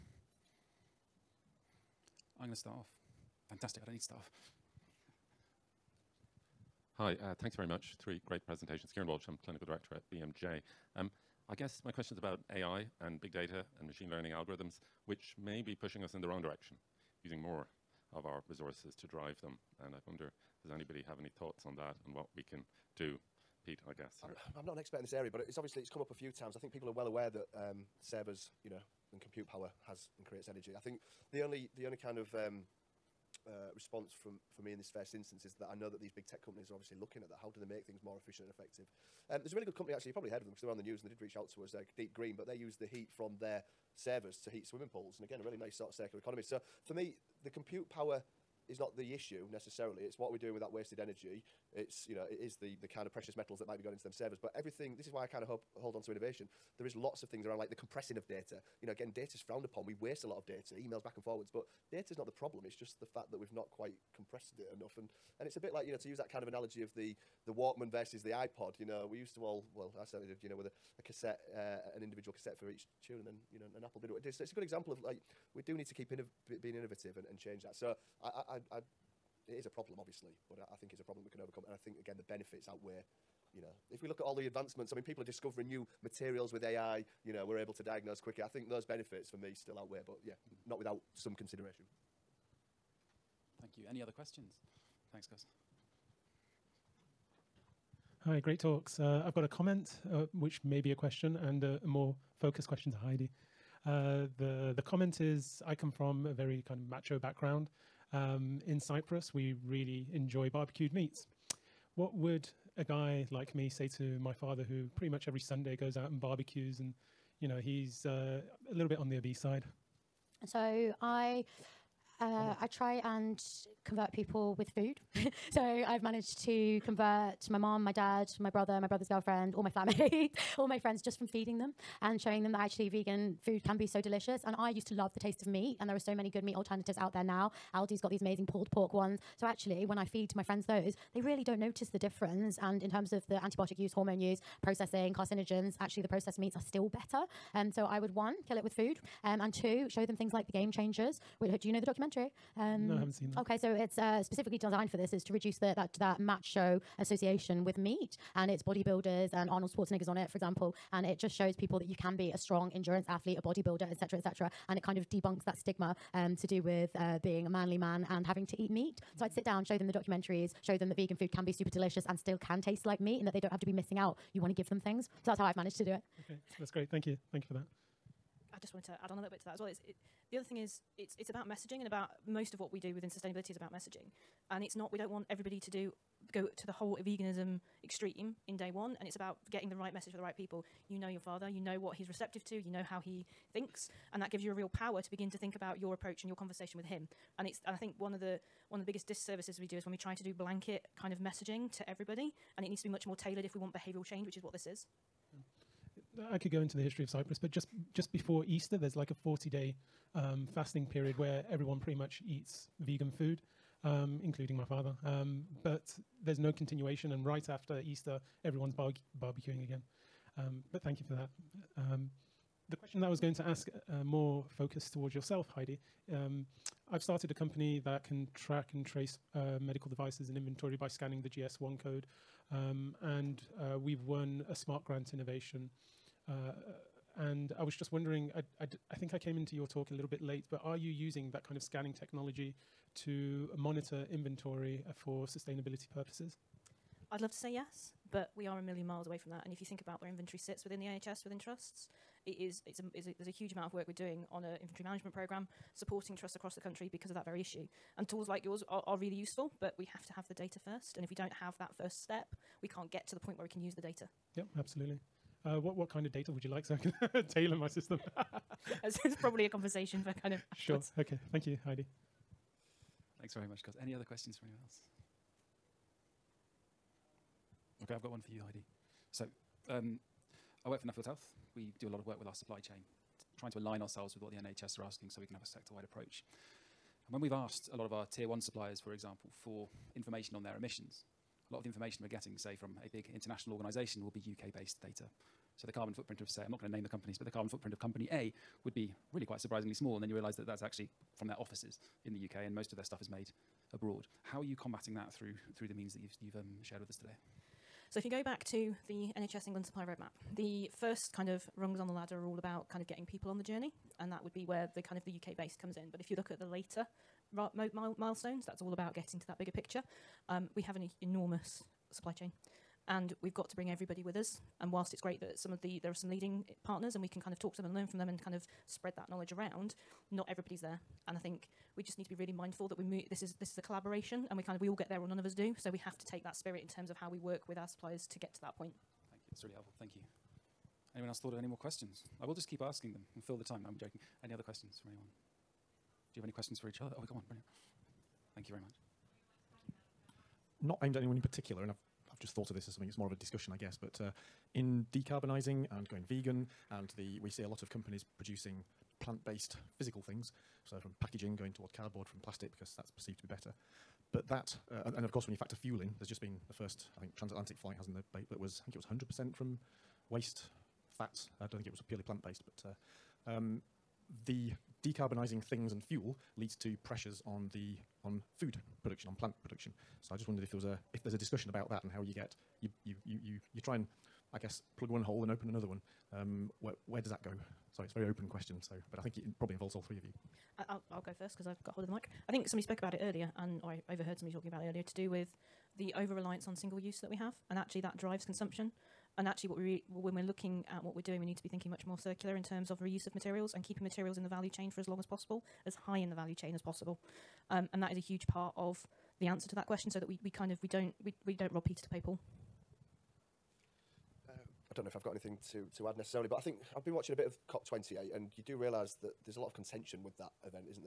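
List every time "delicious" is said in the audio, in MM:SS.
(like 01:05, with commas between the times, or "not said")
02:14, 02:51.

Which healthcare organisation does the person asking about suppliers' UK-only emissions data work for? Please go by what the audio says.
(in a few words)
Nuffield Health.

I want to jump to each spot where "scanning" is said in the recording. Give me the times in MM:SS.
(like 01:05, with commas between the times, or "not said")
03:50, 04:01.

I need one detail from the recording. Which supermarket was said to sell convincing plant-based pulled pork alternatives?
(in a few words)
Aldi.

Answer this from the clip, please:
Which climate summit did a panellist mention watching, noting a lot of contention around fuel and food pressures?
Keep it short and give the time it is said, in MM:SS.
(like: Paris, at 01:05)
COP28, at 06:57.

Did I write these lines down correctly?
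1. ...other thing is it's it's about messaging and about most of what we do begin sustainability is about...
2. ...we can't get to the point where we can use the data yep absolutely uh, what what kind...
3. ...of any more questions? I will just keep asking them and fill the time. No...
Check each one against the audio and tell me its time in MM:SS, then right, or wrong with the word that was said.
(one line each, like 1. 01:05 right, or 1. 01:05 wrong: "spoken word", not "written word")
1. 03:00 wrong: "within", not "begin"
2. 04:22 right
3. 05:41 right.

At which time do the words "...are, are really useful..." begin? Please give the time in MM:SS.
04:18.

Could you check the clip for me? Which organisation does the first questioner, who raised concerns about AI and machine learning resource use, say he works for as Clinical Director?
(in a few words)
BMJ.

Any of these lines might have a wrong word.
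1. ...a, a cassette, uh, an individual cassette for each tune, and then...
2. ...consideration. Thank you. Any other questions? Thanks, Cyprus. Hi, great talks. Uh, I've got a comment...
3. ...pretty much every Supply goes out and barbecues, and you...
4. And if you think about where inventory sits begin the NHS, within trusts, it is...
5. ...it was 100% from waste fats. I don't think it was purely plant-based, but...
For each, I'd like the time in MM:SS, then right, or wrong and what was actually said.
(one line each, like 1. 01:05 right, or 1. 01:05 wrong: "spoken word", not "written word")
1. 01:10 right
2. 01:31 wrong: "Gus", not "Cyprus"
3. 01:54 wrong: "Sunday", not "Supply"
4. 04:09 wrong: "within", not "begin"
5. 06:08 right.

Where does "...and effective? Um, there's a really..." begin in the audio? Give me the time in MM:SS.
00:38.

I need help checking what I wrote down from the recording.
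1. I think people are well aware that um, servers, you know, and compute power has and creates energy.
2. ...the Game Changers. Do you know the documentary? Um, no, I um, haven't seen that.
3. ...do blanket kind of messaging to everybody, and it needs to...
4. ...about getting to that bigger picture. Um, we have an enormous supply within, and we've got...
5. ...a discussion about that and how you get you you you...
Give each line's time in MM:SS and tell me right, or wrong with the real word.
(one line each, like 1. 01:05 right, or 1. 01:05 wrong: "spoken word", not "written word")
1. 00:26 right
2. 02:30 right
3. 03:20 right
4. 05:18 wrong: "chain", not "within"
5. 06:21 right.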